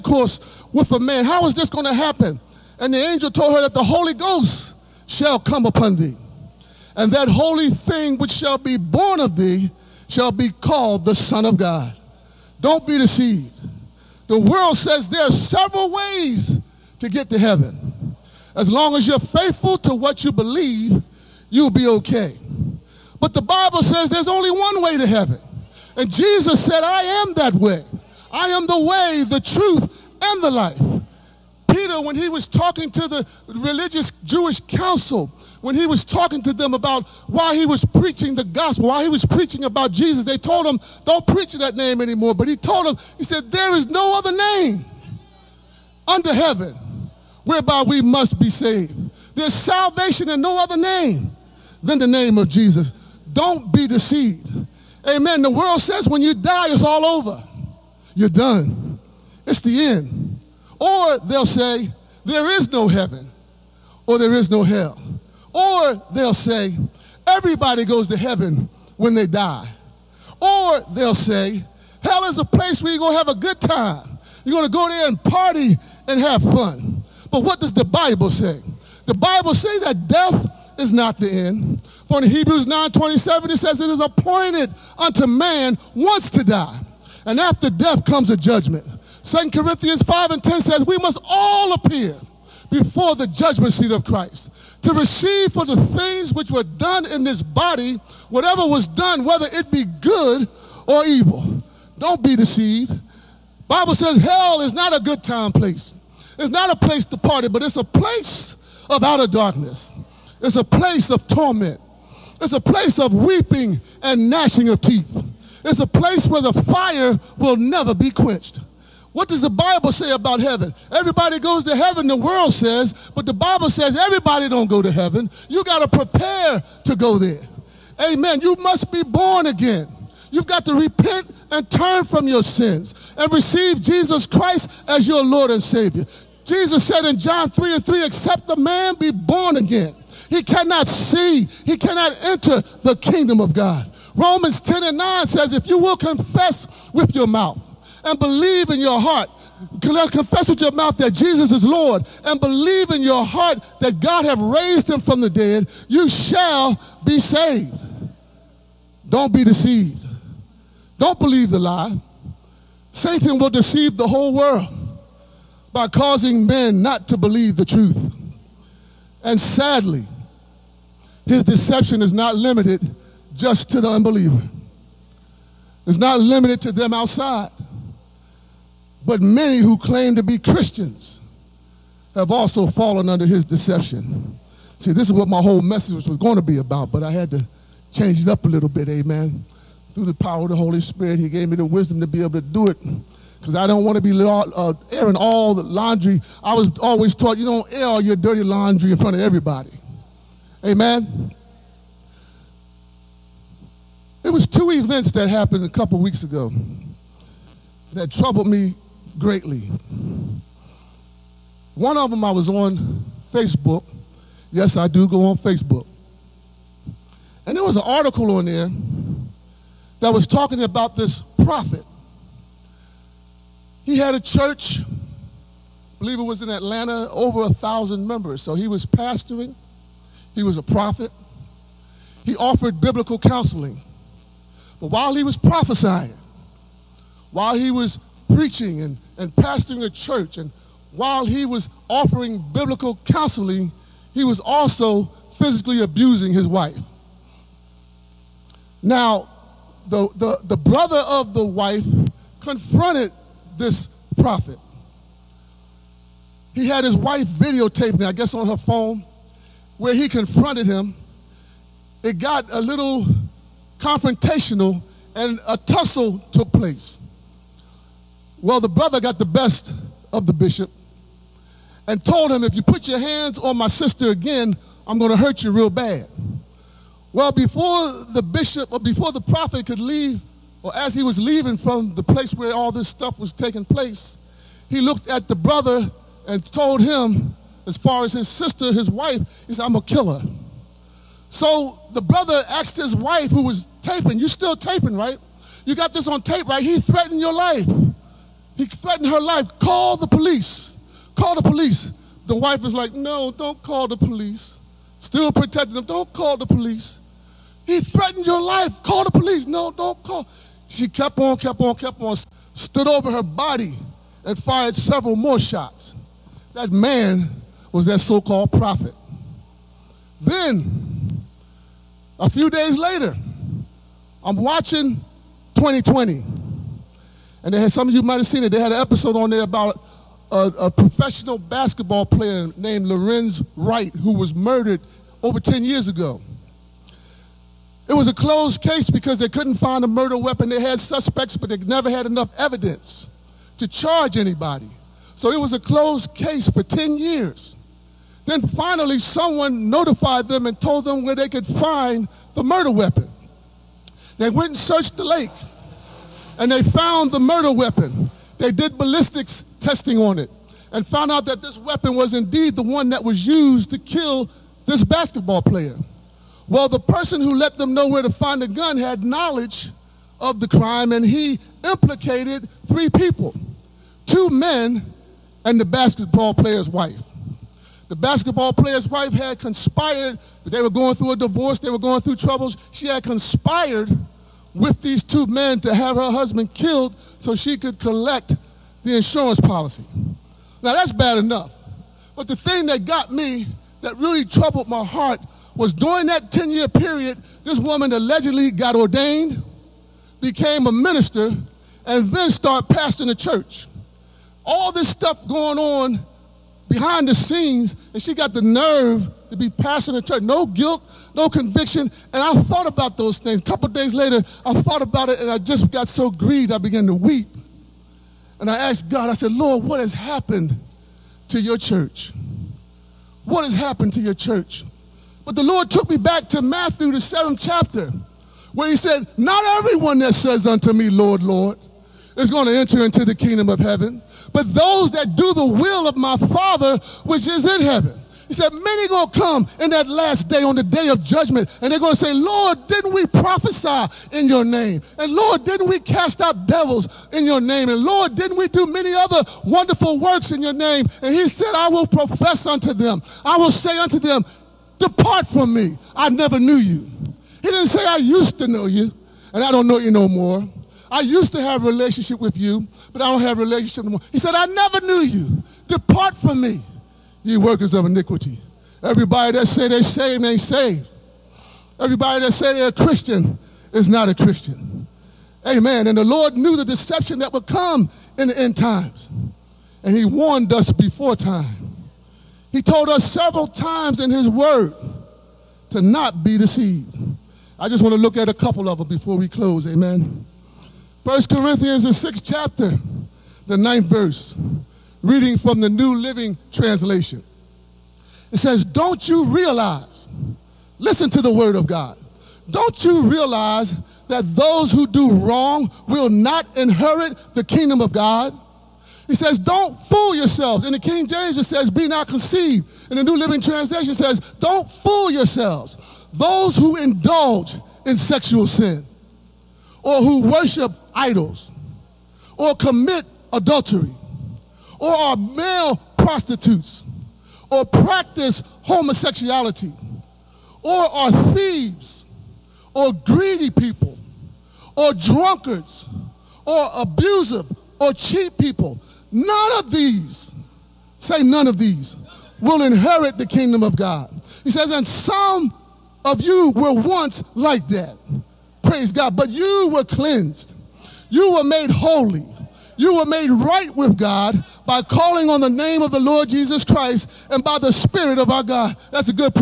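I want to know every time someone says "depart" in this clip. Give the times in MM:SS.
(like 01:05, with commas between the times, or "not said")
07:34, 07:45.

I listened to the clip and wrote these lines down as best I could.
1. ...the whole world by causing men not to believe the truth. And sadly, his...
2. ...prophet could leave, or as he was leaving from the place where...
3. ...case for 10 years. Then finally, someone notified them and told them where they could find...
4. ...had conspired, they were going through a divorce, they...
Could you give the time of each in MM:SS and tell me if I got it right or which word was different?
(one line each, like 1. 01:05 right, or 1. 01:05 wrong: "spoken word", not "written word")
1. 02:43 right
2. 04:39 right
3. 05:46 right
4. 06:19 right.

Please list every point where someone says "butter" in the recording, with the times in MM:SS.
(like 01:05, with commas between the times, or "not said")
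not said.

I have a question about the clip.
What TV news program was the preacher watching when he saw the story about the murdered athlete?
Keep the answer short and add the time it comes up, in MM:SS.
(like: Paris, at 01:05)
20/20, at 05:25.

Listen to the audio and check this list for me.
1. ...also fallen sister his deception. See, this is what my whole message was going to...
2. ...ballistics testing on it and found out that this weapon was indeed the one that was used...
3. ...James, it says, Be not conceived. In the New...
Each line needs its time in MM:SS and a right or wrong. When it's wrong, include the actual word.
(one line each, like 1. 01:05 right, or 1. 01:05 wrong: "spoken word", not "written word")
1. 03:02 wrong: "under", not "sister"
2. 05:58 right
3. 08:31 right.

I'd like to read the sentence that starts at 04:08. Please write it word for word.
Now, the, the, the brother of the wife confronted this prophet.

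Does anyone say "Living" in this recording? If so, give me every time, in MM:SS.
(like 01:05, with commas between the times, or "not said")
08:15, 08:33.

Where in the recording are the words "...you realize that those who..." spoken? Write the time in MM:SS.
08:22.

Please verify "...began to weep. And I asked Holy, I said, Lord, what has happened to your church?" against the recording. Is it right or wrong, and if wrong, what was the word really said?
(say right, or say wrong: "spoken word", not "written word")
wrong: "God", not "Holy".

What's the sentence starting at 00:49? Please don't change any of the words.
There's salvation in no other name than the name of Jesus.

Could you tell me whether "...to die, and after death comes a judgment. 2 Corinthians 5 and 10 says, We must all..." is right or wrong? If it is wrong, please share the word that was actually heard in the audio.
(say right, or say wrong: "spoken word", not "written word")
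right.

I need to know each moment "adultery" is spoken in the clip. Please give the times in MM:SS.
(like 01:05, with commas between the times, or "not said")
08:43.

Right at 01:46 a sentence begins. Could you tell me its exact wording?
It's not a place to party, but it's a place of outer darkness.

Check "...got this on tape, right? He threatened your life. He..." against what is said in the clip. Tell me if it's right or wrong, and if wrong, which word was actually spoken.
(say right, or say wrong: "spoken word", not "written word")
right.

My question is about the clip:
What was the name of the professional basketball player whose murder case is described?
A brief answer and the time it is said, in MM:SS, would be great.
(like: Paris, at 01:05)
Lorenzen Wright, at 05:32.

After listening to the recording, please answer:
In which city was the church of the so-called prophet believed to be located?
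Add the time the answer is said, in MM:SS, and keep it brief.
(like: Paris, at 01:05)
Atlanta, at 03:46.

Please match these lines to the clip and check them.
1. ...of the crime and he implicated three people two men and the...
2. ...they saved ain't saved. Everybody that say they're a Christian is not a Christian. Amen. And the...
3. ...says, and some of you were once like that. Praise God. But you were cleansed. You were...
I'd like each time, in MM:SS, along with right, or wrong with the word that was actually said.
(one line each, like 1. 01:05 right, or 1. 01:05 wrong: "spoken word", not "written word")
1. 06:10 right
2. 07:49 right
3. 09:04 right.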